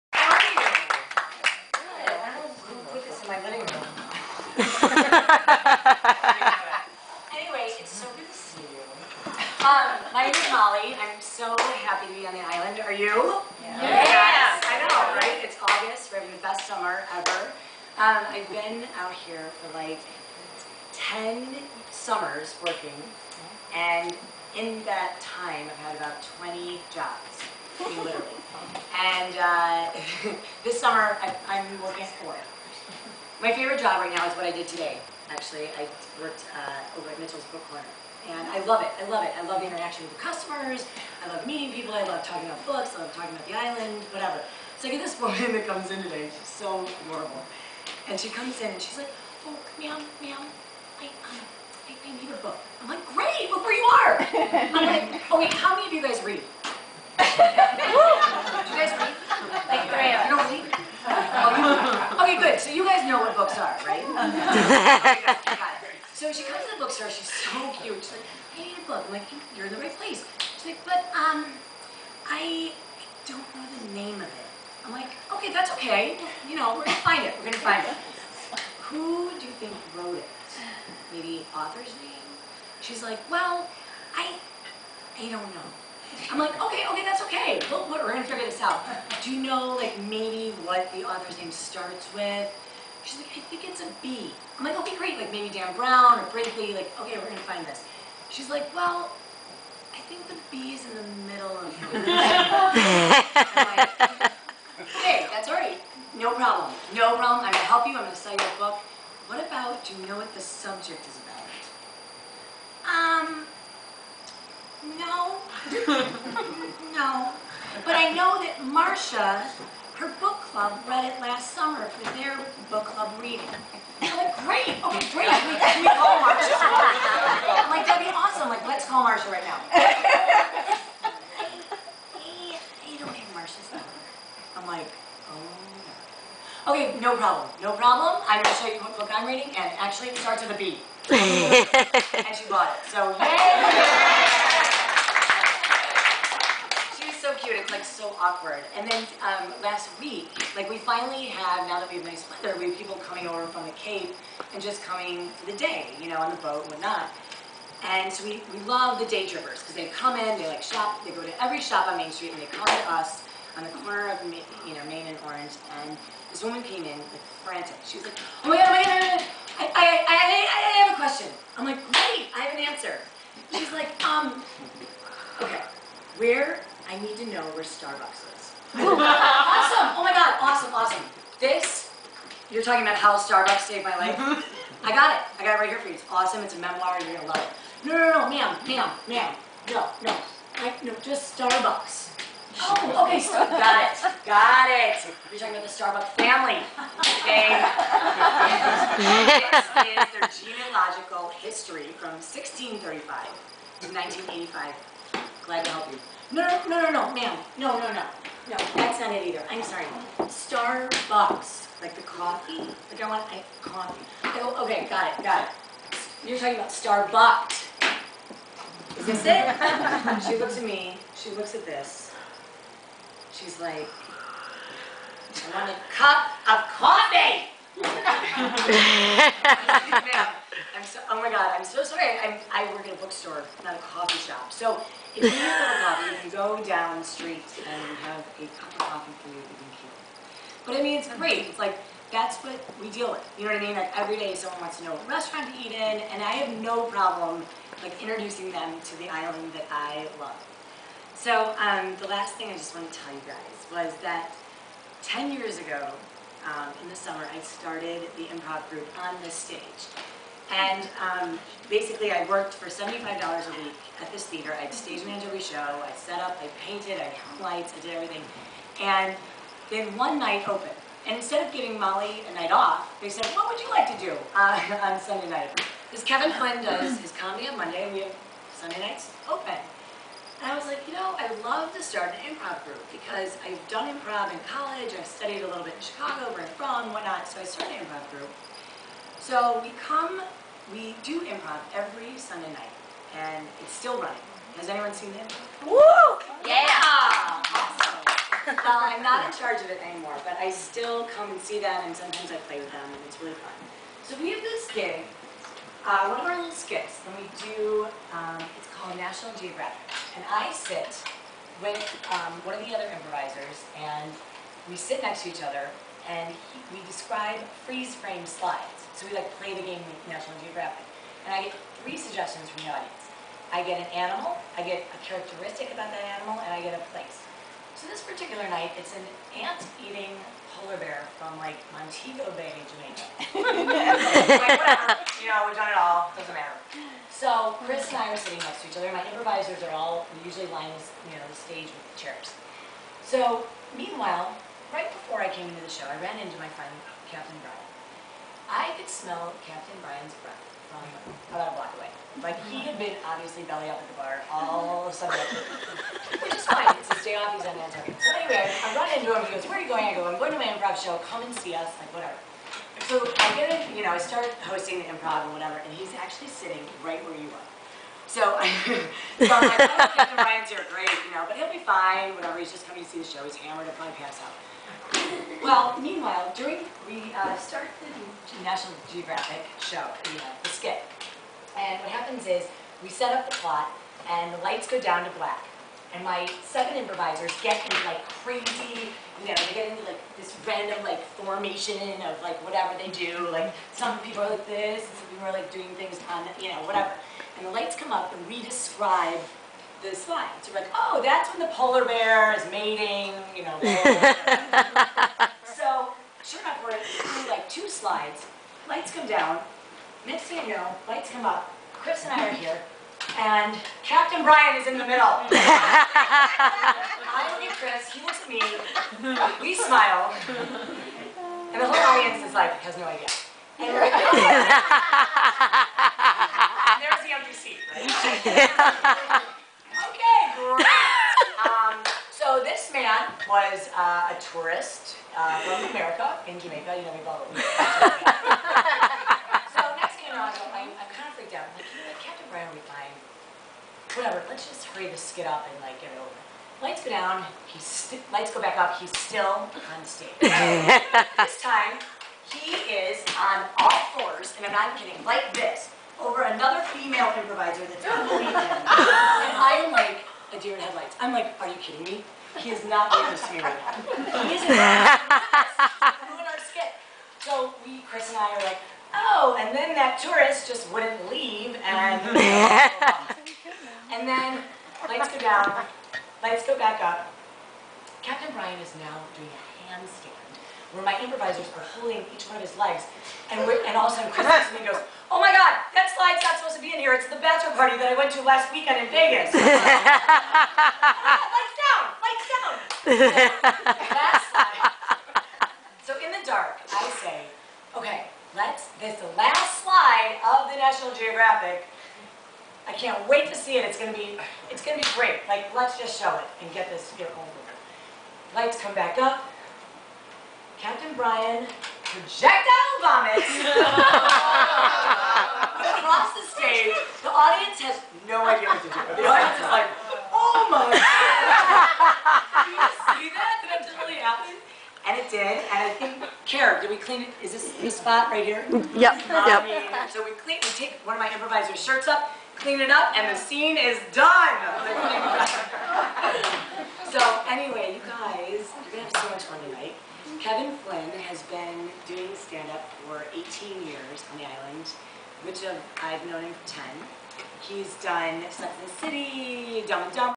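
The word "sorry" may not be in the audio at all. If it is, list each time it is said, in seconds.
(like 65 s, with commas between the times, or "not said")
209 s, 231 s.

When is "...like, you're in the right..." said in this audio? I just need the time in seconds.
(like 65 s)
69 s.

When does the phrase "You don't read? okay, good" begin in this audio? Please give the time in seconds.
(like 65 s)
60 s.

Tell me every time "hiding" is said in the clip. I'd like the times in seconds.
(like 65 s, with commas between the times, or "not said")
not said.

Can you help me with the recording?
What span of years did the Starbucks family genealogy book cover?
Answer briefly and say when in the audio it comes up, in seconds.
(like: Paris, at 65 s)
1635 to 1985, at 202 s.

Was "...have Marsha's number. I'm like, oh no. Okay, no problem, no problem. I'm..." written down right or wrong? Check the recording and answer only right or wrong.
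right.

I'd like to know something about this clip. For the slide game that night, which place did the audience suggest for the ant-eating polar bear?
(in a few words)
Montego Bay, Jamaica.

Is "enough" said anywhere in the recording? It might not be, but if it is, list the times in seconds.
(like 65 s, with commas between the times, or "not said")
406 s.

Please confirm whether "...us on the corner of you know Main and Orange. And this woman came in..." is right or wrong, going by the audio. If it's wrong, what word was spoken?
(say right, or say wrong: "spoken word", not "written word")
right.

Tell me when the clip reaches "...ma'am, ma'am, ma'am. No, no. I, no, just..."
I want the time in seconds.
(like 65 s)
188 s.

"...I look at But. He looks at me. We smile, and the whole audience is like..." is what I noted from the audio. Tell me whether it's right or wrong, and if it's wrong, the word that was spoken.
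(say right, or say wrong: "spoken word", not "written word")
wrong: "Chris", not "But".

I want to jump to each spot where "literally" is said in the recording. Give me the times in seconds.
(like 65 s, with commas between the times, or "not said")
27 s.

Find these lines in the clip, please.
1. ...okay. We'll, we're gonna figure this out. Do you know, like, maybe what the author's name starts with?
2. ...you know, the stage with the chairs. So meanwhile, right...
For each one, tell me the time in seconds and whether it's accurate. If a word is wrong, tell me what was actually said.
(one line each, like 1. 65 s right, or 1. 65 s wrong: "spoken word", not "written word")
1. 87 s right
2. 341 s right.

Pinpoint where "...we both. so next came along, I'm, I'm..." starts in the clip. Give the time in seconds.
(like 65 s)
436 s.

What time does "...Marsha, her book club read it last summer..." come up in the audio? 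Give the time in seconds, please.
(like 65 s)
119 s.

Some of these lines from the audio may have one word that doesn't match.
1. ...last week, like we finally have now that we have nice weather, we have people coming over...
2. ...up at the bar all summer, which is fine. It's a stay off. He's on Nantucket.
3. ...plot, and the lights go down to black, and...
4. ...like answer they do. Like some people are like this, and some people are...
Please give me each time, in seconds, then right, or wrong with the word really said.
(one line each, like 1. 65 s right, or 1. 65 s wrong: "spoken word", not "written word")
1. 149 s right
2. 353 s right
3. 383 s right
4. 392 s wrong: "whatever", not "answer".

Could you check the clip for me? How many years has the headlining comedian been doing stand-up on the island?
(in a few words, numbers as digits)
18.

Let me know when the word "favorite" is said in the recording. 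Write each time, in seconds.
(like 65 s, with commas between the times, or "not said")
33 s.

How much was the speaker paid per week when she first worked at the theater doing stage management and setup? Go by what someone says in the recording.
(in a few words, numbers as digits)
$75.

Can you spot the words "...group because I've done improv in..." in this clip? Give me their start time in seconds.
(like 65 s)
282 s.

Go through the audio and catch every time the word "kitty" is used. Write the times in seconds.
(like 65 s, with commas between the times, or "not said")
not said.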